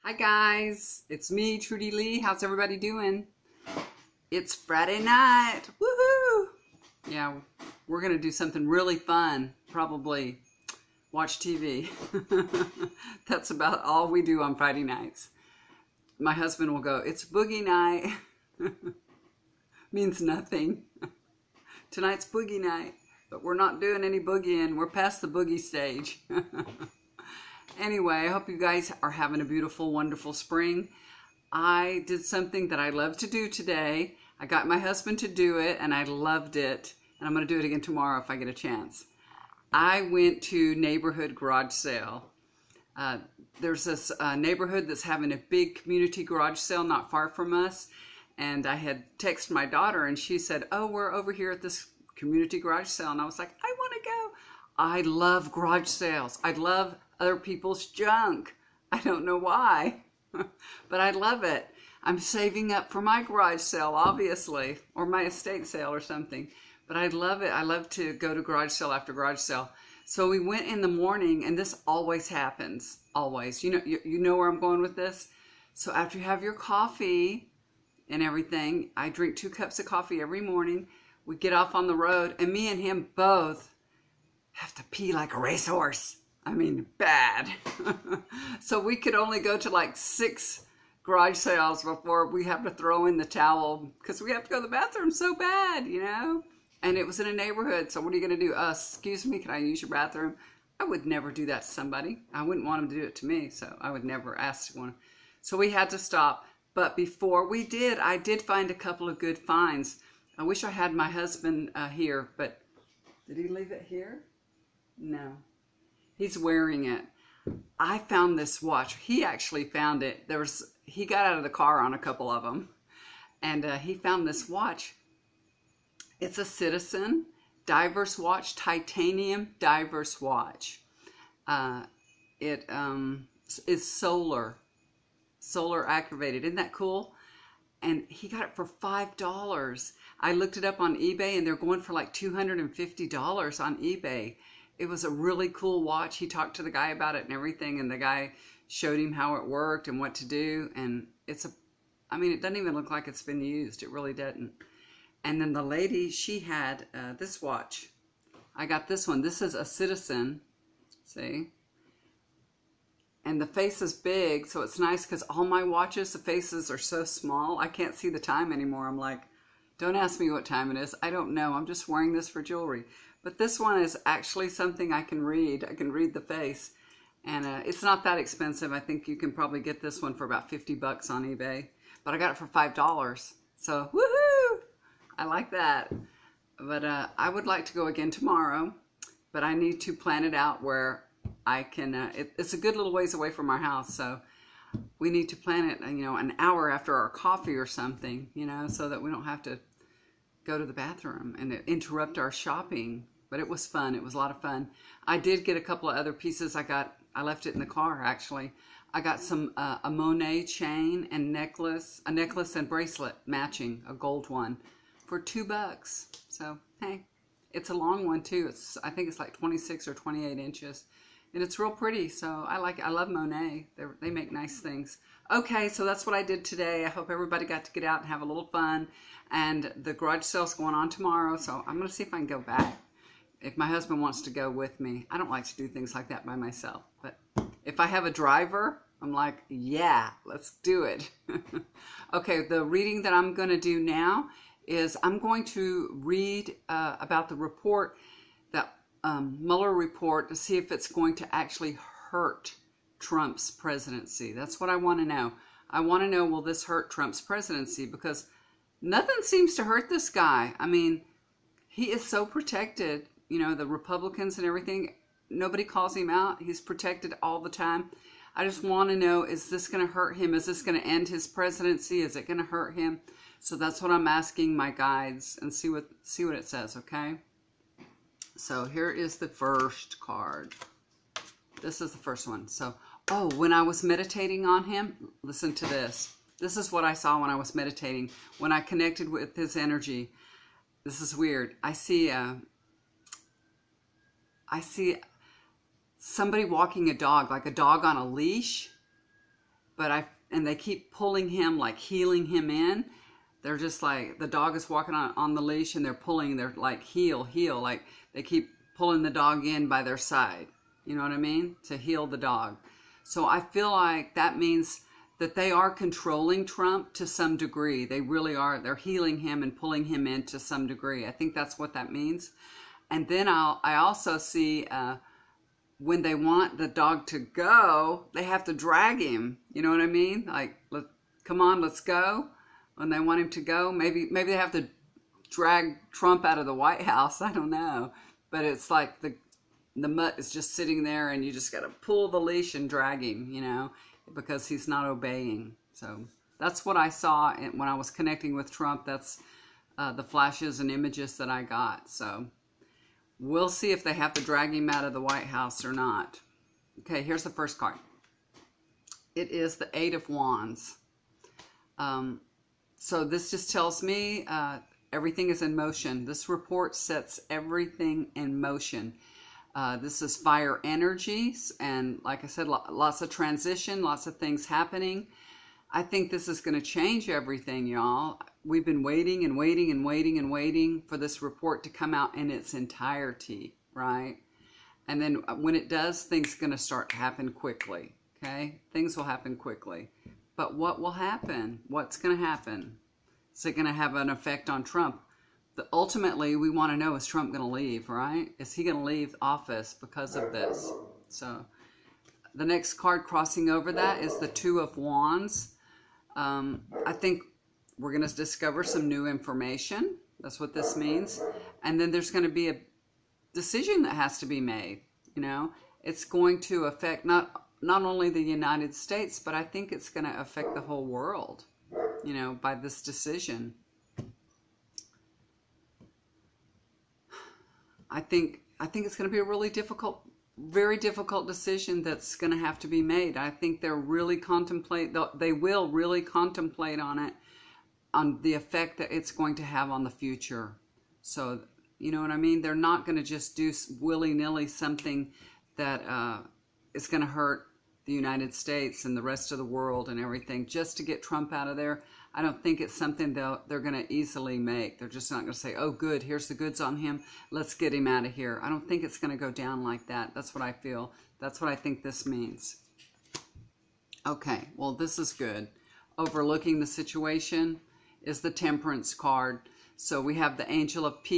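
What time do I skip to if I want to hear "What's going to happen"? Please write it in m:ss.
6:31.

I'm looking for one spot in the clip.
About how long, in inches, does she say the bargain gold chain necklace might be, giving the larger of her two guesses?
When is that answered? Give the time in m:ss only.
3:39.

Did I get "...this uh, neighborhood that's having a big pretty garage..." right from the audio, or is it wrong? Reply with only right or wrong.
wrong.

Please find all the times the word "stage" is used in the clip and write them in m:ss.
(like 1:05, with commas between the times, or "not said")
0:25.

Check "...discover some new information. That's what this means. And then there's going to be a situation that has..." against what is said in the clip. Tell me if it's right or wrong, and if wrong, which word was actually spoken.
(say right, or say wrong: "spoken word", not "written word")
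wrong: "decision", not "situation".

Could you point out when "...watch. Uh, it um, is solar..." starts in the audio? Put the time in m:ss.
2:10.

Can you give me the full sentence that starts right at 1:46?
But before we did, I did find a couple of good finds.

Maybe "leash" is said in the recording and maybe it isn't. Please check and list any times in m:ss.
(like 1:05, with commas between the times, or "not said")
4:58, 5:05, 5:42.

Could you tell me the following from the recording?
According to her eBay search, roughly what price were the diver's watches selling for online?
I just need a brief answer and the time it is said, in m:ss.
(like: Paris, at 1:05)
$250, at 2:22.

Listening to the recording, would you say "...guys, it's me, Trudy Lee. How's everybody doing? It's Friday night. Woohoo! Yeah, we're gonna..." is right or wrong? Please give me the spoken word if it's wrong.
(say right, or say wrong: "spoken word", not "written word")
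right.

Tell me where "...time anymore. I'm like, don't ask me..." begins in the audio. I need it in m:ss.
2:48.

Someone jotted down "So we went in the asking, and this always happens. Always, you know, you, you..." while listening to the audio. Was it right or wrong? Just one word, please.
wrong.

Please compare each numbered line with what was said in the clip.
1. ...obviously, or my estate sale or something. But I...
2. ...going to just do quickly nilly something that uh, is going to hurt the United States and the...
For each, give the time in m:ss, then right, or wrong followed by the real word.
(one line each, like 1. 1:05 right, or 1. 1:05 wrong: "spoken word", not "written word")
1. 1:03 right
2. 7:22 wrong: "willy", not "quickly".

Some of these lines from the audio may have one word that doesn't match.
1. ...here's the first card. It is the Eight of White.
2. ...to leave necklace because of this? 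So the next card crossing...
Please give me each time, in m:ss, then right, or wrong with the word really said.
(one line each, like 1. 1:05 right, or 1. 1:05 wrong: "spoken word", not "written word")
1. 5:57 wrong: "Wands", not "White"
2. 6:38 wrong: "office", not "necklace".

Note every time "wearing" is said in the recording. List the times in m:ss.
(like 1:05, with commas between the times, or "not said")
1:56, 2:51.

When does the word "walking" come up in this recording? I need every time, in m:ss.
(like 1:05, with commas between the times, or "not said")
4:56, 5:04.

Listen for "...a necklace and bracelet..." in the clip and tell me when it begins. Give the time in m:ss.
3:32.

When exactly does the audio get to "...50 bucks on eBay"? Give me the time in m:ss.
3:00.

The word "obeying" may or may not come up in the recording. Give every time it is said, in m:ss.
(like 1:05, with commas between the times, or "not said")
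5:44.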